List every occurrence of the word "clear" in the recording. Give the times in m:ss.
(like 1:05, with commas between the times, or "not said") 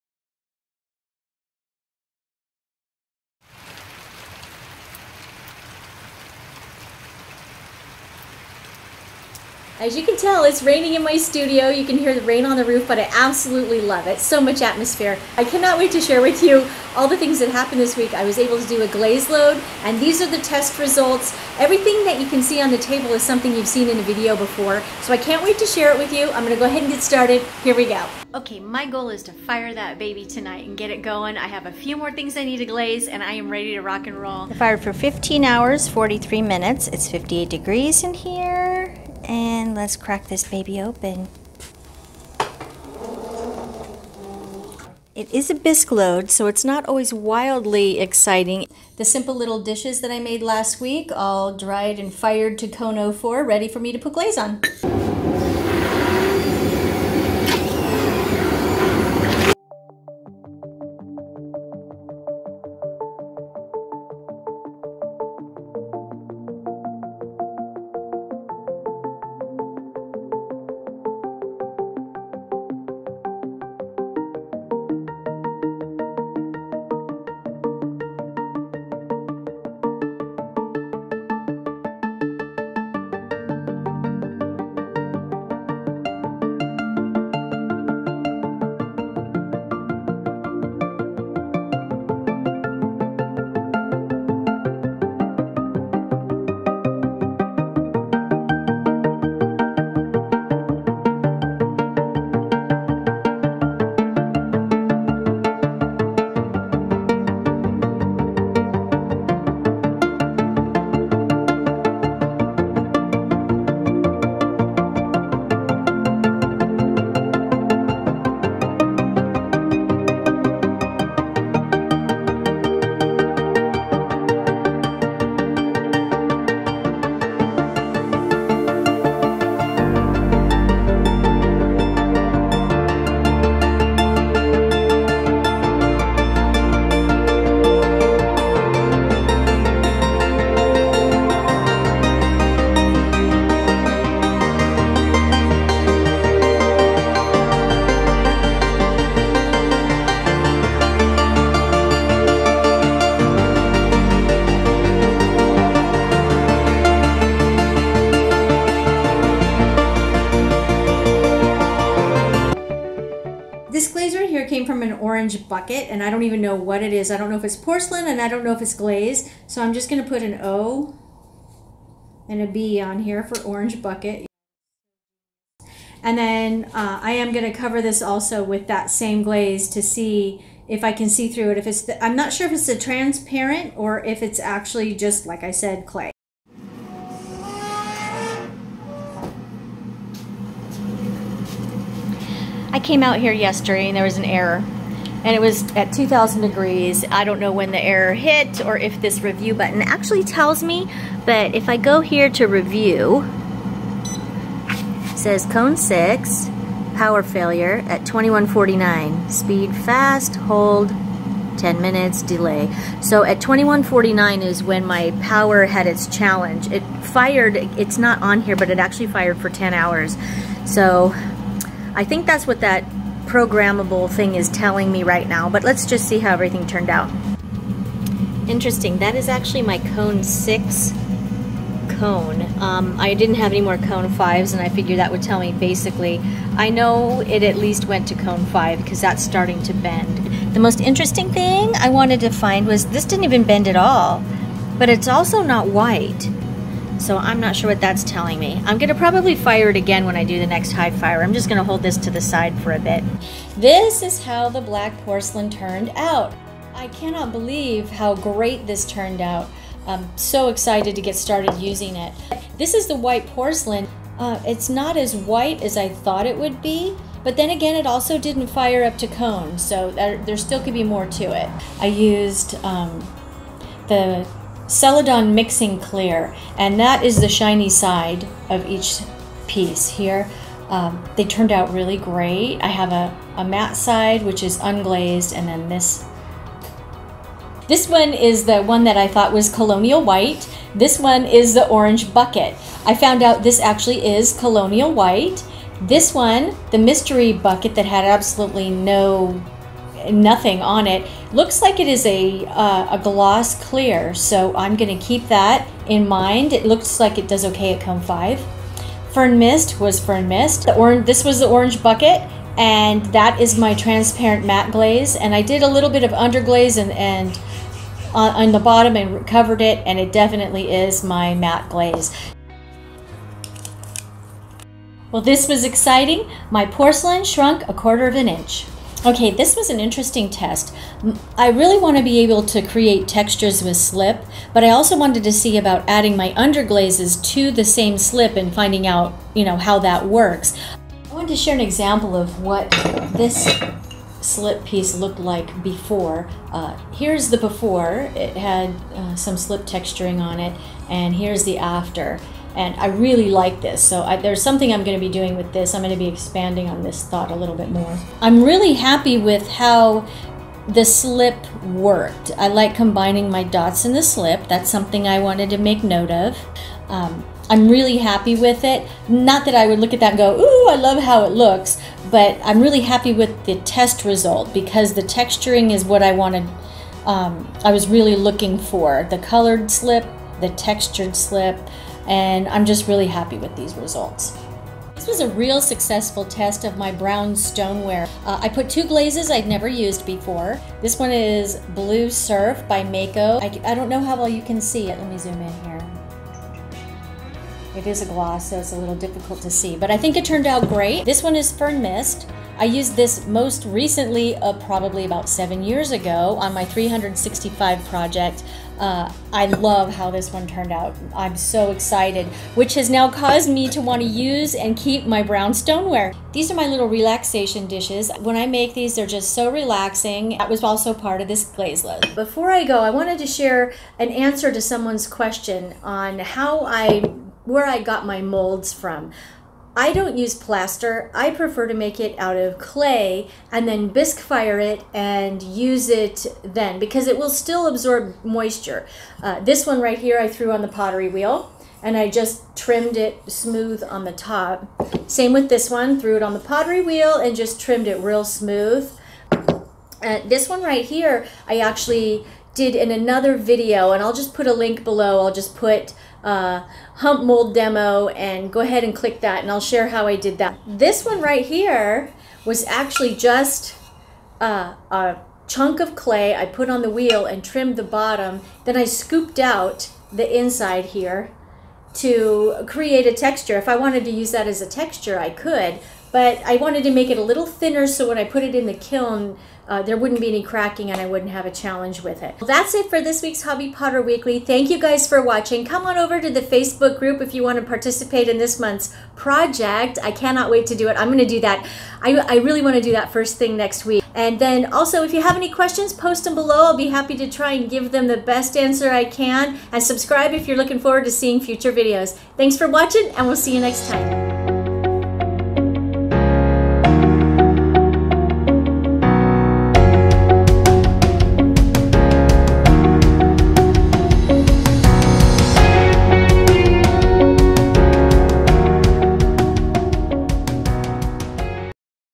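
4:35, 5:03.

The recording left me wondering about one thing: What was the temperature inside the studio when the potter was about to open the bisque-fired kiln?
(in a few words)
58 degrees.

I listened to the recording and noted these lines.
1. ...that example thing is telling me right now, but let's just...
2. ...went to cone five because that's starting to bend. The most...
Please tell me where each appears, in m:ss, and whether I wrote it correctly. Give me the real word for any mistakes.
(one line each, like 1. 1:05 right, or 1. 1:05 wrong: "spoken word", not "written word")
1. 3:42 wrong: "programmable", not "example"
2. 3:57 right.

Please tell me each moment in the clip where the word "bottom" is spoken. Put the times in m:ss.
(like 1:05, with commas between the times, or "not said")
5:18, 7:47.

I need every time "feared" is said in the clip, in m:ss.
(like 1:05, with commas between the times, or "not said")
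not said.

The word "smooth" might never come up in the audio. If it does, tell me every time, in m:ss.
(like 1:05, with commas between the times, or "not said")
7:23, 7:28.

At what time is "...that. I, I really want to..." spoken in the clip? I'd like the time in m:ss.
8:11.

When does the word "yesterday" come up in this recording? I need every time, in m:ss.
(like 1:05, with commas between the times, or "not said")
3:13.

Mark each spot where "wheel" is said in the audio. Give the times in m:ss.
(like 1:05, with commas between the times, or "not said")
7:21, 7:26, 7:46.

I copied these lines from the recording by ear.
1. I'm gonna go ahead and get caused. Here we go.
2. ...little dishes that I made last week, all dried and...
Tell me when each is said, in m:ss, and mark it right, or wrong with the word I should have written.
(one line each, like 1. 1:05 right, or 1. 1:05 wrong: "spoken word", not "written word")
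1. 0:26 wrong: "started", not "caused"
2. 0:49 right.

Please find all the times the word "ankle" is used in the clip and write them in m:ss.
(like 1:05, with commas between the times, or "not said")
not said.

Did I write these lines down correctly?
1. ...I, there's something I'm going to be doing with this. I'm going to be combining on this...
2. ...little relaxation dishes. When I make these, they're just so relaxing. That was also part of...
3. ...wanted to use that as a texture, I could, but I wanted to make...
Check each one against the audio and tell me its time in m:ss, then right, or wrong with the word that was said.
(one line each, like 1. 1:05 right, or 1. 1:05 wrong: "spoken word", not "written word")
1. 5:54 wrong: "expanding", not "combining"
2. 6:56 right
3. 7:53 right.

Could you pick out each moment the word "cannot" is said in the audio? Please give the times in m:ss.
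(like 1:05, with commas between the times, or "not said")
0:15, 4:16, 8:10.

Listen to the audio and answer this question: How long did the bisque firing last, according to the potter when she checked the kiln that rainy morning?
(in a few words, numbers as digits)
15 hours, 43 minutes.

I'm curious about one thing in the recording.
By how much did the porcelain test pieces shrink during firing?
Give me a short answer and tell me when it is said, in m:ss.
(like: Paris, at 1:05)
a quarter of an inch, at 5:27.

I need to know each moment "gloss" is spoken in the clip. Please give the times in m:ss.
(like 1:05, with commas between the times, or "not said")
5:03, 6:38.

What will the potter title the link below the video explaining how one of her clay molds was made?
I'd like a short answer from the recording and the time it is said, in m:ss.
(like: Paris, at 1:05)
hump mold demo, at 7:36.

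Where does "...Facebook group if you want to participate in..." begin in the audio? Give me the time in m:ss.
8:06.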